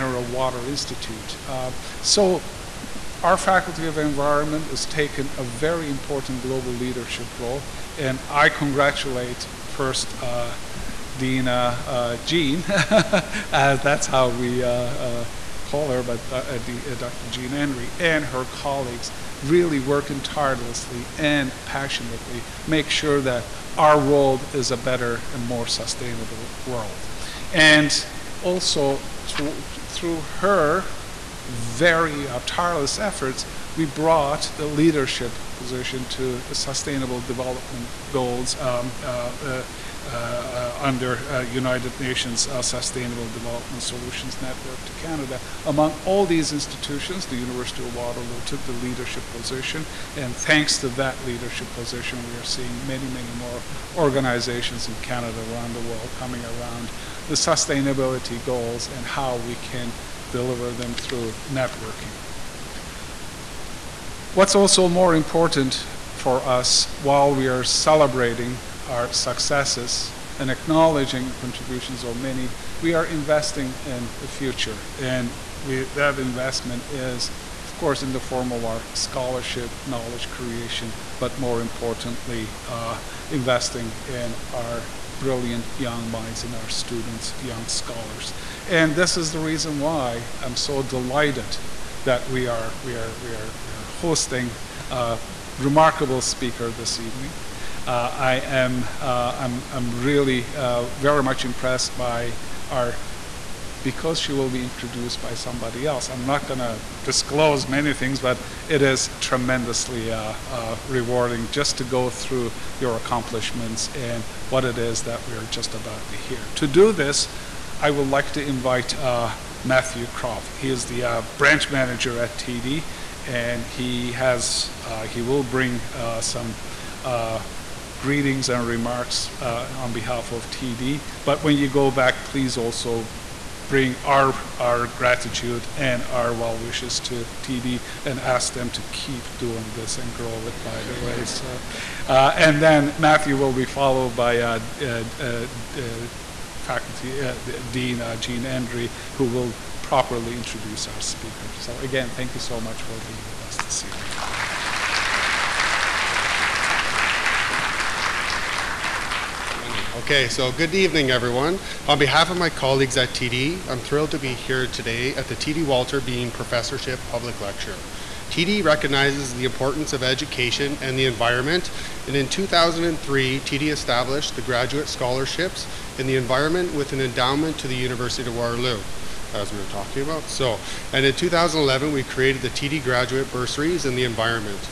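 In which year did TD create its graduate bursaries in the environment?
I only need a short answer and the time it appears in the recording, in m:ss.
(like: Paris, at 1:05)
2011, at 3:01.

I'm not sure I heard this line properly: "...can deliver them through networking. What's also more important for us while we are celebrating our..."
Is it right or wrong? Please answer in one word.
right.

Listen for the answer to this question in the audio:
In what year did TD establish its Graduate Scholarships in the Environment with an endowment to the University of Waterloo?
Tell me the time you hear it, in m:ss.
2:52.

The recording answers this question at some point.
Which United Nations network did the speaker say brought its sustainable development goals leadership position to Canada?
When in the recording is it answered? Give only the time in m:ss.
0:42.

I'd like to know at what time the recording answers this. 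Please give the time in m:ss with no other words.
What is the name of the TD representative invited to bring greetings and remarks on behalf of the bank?
1:59.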